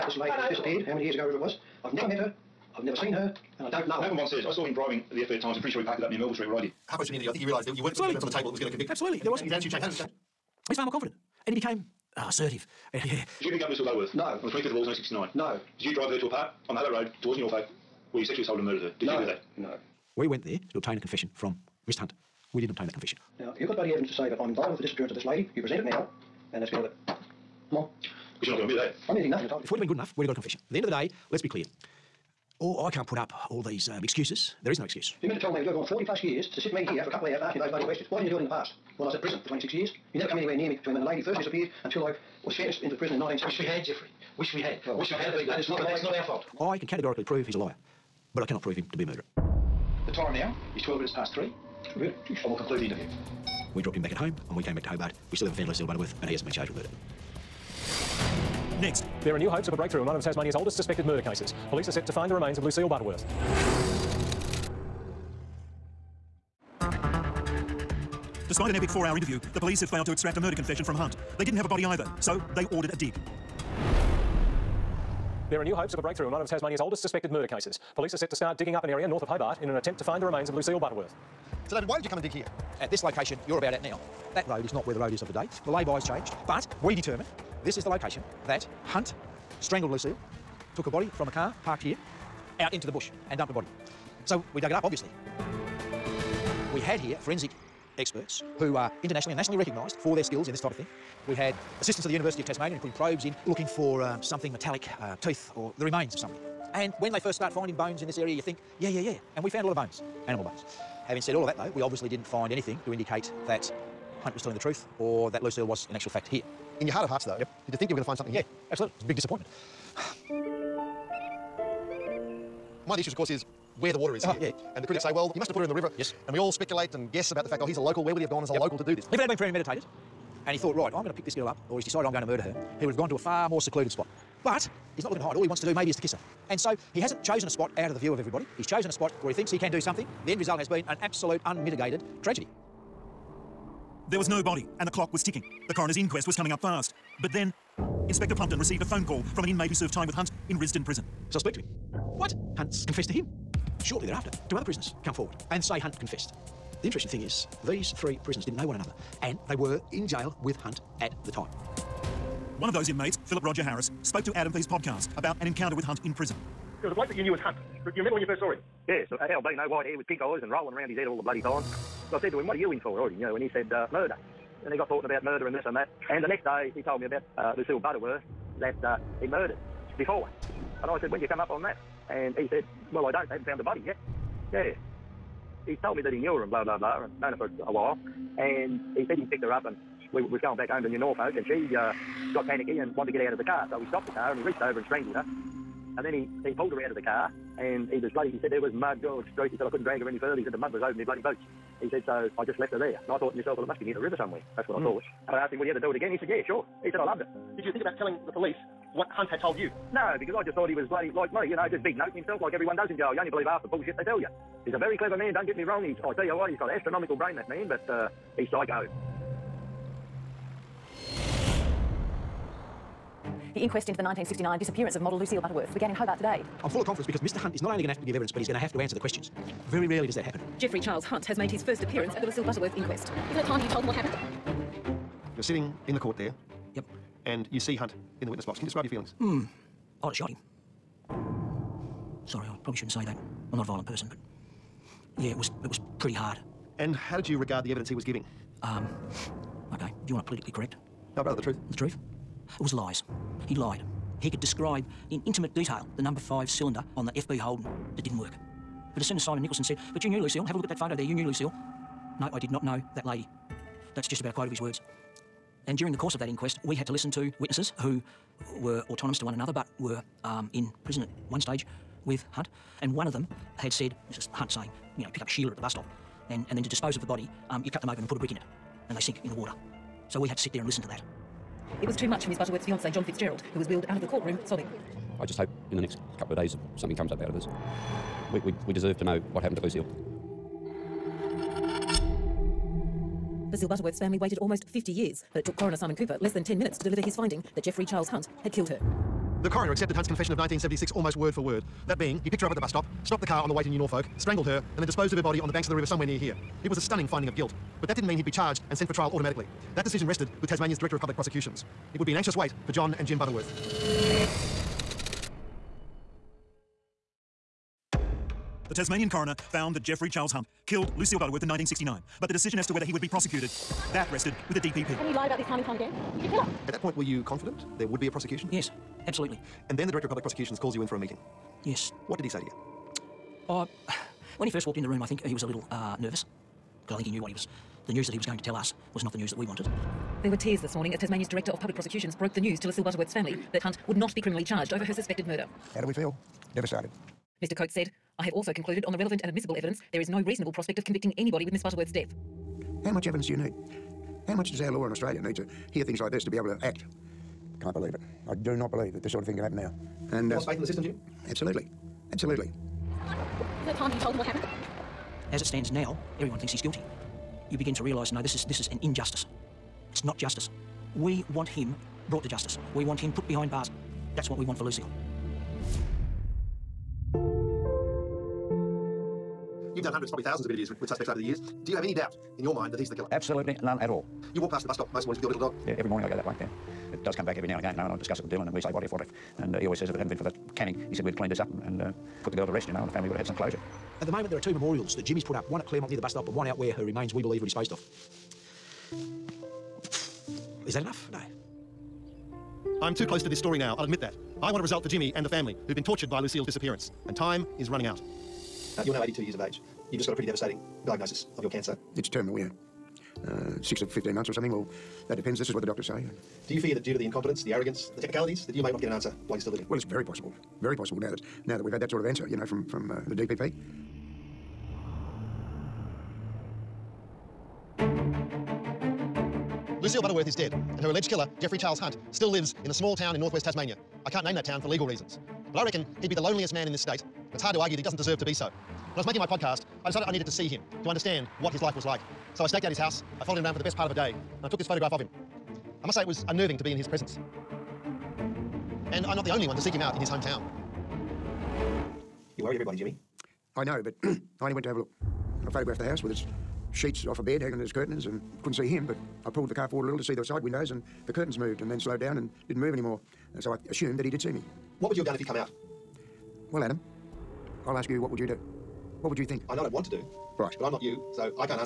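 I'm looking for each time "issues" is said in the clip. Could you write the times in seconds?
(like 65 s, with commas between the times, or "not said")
122 s.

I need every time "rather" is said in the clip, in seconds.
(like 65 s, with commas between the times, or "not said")
251 s.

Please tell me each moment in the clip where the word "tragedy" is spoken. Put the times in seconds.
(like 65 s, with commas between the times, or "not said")
142 s.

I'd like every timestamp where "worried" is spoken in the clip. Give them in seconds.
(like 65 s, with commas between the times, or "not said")
452 s.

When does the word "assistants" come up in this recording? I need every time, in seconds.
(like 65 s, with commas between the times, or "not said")
101 s.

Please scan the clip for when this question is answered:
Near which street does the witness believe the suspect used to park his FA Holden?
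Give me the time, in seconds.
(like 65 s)
6 s.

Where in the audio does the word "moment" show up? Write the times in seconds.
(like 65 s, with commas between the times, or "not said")
394 s.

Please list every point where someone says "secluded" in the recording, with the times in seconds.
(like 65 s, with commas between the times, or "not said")
133 s.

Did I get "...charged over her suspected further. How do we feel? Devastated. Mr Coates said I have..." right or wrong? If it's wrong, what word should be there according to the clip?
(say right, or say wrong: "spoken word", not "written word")
wrong: "murder", not "further".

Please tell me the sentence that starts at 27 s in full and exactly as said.
Come on because you're not going to admit it, are you?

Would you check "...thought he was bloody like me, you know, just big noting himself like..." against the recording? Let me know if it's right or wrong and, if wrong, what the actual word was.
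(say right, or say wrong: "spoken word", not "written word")
right.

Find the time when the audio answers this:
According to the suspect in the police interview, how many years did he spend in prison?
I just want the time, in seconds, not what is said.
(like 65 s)
39 s.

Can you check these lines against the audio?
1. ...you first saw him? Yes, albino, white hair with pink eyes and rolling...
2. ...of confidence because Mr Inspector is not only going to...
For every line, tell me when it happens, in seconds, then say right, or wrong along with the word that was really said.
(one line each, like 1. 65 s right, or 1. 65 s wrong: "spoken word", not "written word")
1. 168 s right
2. 226 s wrong: "Hunt", not "Inspector".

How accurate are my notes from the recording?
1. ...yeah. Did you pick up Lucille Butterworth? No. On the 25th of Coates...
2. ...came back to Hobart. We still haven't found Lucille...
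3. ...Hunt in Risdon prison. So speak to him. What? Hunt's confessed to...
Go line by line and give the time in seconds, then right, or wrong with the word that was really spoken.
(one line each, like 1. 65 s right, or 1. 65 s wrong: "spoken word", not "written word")
1. 12 s wrong: "August", not "Coates"
2. 54 s right
3. 150 s right.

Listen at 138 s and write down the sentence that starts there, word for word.
He's chosen a spot where he thinks he can do something.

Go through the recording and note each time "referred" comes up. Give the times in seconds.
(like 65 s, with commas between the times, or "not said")
not said.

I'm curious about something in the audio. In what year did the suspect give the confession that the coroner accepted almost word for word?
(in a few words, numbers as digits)
1976.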